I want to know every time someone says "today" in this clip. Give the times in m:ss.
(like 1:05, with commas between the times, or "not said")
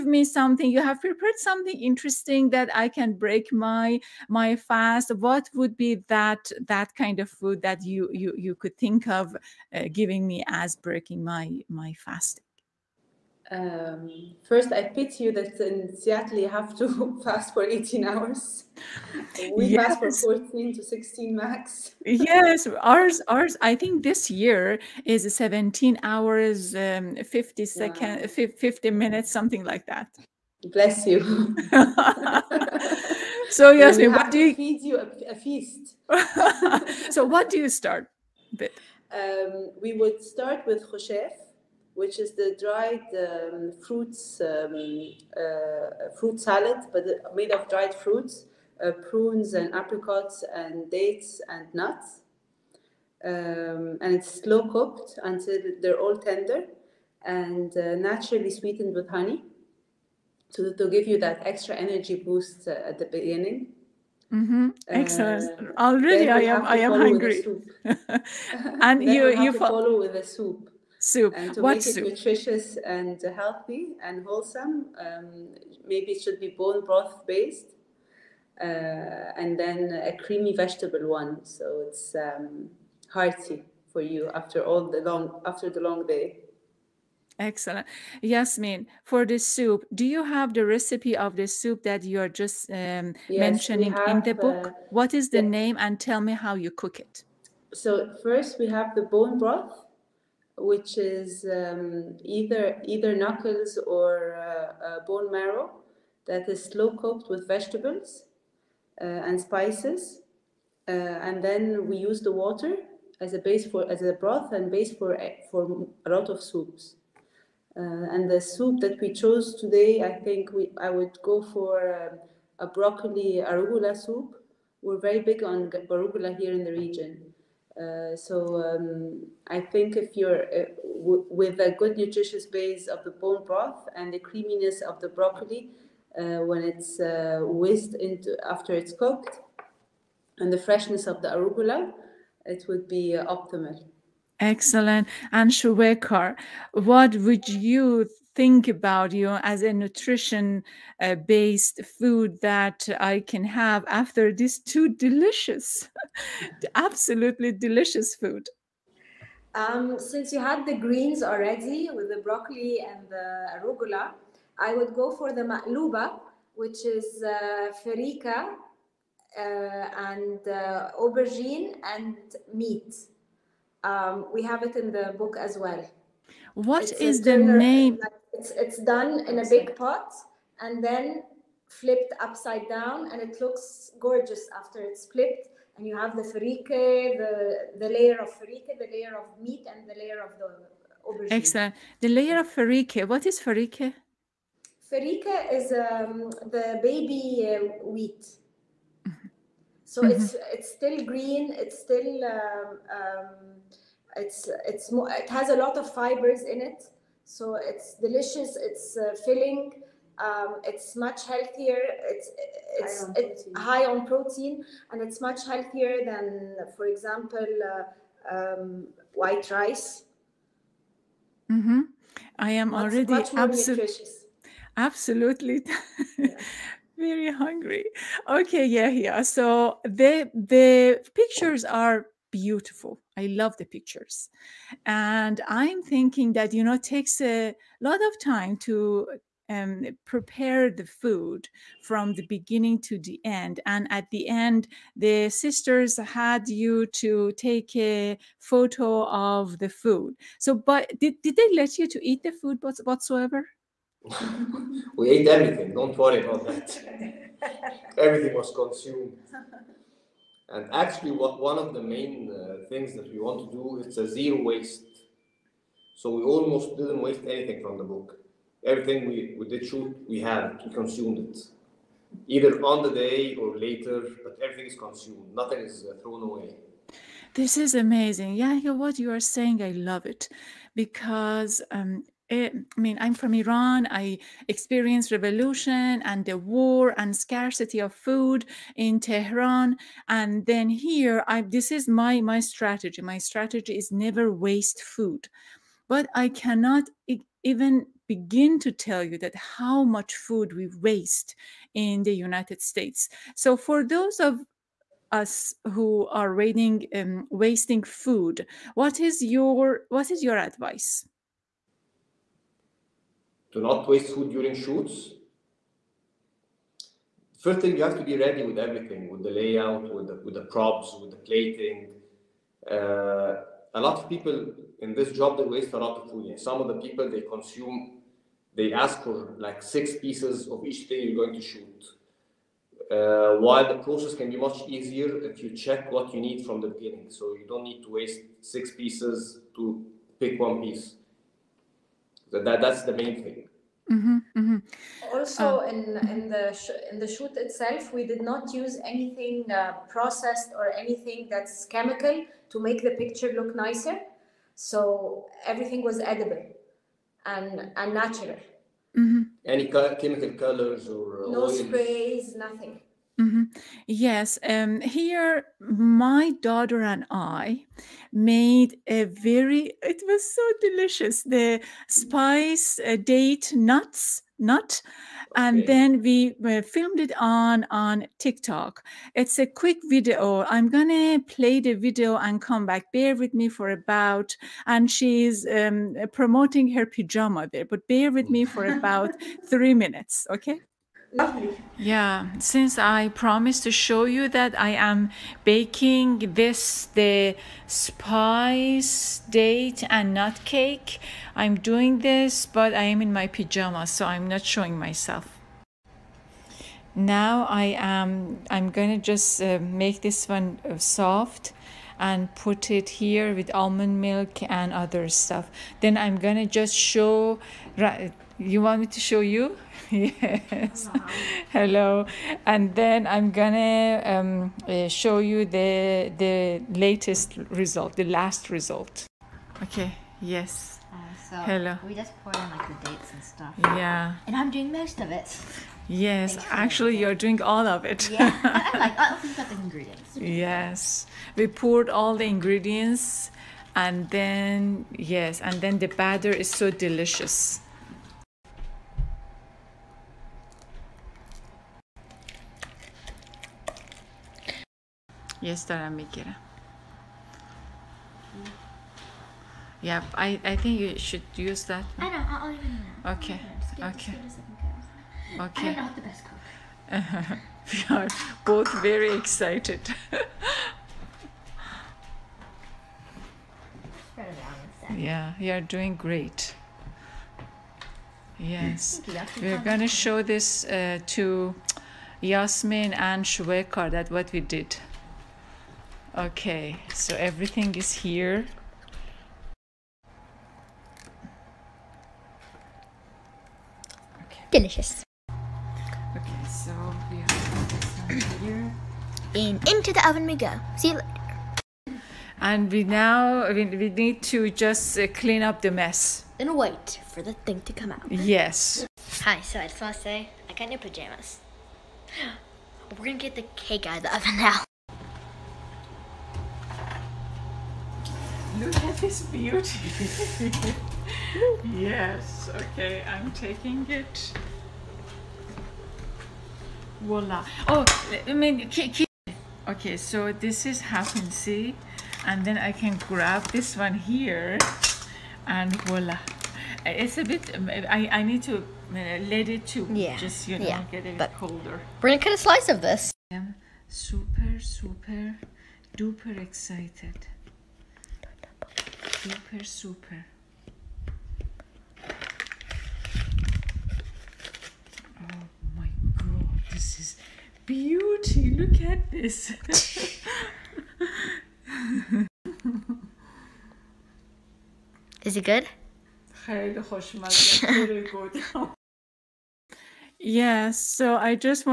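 1:59.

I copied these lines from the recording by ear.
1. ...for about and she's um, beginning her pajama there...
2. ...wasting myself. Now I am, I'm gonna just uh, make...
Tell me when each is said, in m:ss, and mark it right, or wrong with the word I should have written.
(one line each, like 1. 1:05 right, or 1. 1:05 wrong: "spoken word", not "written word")
1. 6:23 wrong: "promoting", not "beginning"
2. 6:44 wrong: "showing", not "wasting".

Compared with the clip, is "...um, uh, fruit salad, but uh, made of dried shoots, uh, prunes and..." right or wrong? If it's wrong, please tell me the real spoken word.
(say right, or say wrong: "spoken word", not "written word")
wrong: "fruits", not "shoots".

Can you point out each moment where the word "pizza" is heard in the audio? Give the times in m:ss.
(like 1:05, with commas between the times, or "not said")
not said.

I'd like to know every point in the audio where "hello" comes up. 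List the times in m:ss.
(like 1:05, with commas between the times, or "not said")
7:01, 7:11.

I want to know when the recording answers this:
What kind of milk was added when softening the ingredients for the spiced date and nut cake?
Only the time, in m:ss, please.
6:53.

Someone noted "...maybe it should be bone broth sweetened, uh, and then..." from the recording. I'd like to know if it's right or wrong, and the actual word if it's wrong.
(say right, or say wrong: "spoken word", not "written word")
wrong: "based", not "sweetened".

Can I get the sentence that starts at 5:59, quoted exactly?
Any co- chemical colors or no oils?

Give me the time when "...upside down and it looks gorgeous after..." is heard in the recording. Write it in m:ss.
3:02.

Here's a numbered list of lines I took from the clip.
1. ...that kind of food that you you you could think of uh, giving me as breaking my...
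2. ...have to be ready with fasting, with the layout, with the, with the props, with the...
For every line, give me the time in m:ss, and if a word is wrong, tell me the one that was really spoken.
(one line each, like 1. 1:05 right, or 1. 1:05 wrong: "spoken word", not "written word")
1. 0:06 right
2. 5:17 wrong: "everything", not "fasting".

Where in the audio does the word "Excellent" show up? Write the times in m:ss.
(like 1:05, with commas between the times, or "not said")
1:04, 1:27, 2:24, 3:11.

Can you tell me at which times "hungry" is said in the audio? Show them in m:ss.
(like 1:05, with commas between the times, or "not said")
1:06, 3:47.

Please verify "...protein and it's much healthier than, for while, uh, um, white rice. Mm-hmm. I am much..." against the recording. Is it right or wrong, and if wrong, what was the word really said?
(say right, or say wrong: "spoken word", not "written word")
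wrong: "example", not "while".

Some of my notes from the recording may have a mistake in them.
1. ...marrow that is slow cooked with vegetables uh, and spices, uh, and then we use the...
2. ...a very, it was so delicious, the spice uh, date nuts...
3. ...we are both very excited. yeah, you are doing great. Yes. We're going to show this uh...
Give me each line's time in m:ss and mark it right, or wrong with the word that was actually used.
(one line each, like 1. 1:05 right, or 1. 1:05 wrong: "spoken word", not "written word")
1. 1:45 right
2. 6:08 right
3. 7:47 right.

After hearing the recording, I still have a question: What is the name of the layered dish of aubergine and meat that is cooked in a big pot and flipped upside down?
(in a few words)
Ma'luba.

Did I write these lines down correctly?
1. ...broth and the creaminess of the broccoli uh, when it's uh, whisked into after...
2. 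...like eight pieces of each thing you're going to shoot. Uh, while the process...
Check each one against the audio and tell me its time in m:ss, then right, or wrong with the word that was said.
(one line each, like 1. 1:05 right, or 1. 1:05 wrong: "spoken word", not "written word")
1. 2:13 right
2. 5:29 wrong: "six", not "eight".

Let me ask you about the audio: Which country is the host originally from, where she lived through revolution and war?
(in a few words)
Iran.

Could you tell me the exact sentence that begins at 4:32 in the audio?
Either on the day or later, but everything is consumed.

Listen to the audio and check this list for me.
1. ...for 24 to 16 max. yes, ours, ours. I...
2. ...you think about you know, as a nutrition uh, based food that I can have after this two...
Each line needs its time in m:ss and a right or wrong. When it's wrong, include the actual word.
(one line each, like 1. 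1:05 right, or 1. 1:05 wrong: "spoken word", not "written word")
1. 0:20 wrong: "14", not "24"
2. 2:27 right.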